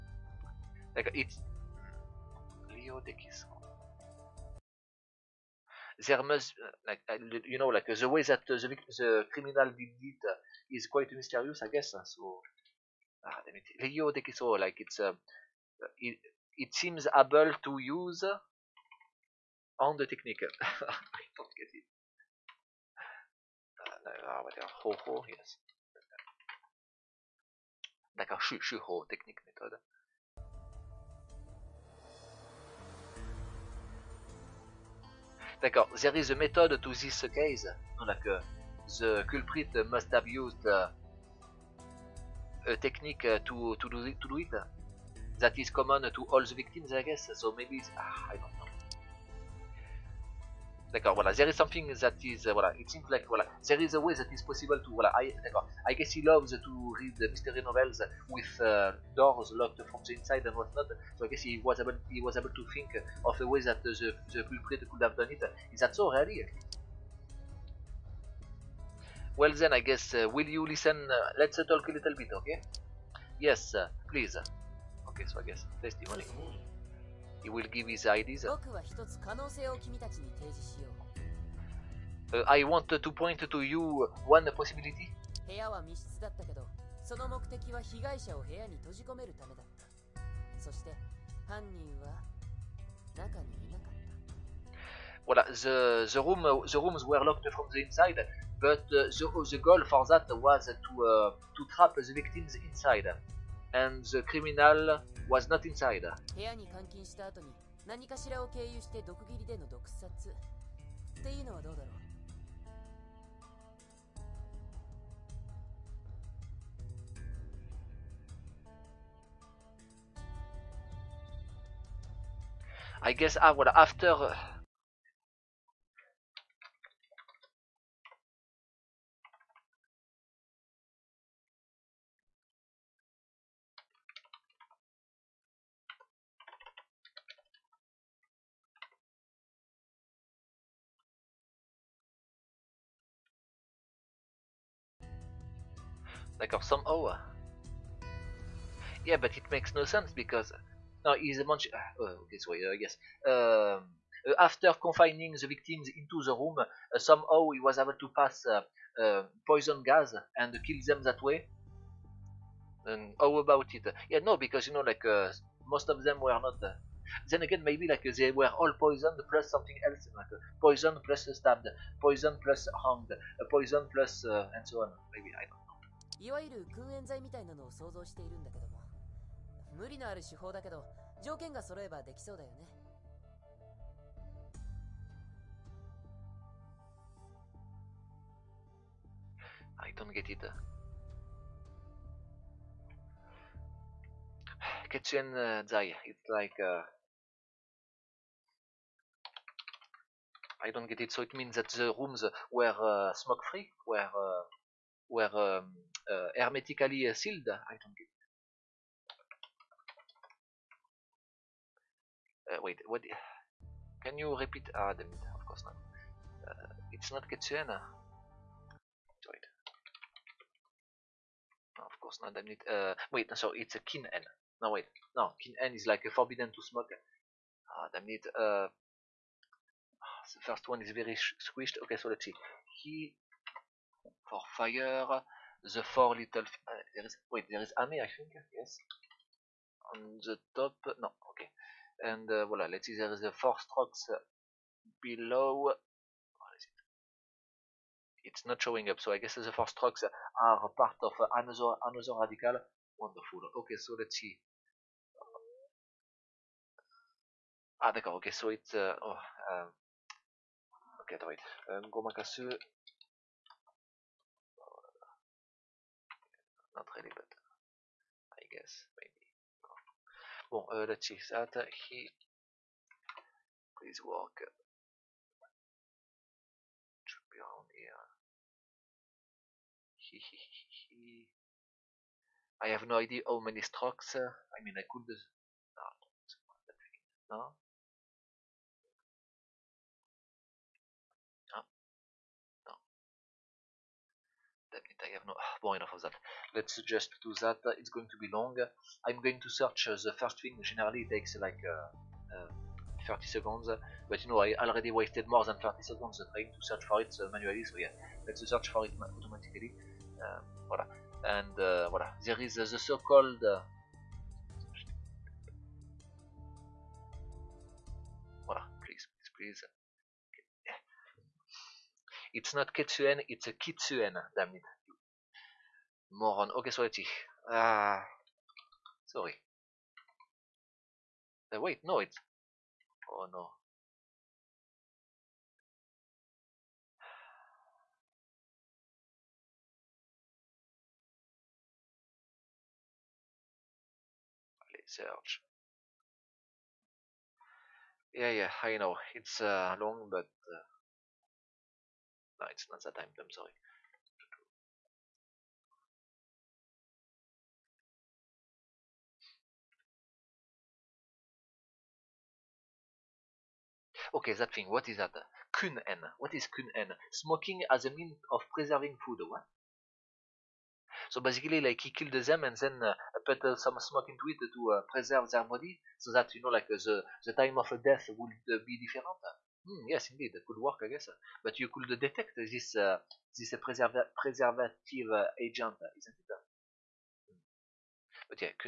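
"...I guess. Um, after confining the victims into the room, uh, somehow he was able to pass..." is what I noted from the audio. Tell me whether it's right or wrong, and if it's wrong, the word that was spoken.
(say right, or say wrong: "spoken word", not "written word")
right.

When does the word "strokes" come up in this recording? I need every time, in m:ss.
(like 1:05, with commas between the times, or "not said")
4:03, 4:09, 4:43.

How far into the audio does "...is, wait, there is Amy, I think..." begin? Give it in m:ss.
3:57.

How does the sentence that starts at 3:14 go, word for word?
Ketchuan uh, Zai, it's like uh, I don't get it.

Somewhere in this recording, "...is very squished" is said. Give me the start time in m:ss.
3:50.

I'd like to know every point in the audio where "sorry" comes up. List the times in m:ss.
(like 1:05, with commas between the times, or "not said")
5:29, 5:53.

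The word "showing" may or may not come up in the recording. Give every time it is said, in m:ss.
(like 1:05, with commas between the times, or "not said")
4:08.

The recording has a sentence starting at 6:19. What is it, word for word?
Hmm, yes, indeed, it could work, I guess.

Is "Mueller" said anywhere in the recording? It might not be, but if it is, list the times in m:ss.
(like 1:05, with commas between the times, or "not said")
not said.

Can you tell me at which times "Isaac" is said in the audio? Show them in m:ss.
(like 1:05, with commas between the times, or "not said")
not said.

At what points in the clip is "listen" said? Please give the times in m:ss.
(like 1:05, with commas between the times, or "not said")
1:10.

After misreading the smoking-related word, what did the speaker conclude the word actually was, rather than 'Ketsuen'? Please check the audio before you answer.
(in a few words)
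Kitsuen.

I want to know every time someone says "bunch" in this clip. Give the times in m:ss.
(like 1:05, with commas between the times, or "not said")
2:31.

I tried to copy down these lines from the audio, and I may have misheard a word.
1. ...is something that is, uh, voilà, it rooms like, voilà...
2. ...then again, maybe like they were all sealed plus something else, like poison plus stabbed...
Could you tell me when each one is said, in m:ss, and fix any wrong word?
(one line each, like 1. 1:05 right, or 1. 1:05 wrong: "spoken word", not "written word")
1. 0:51 wrong: "seems", not "rooms"
2. 2:47 wrong: "poisoned", not "sealed".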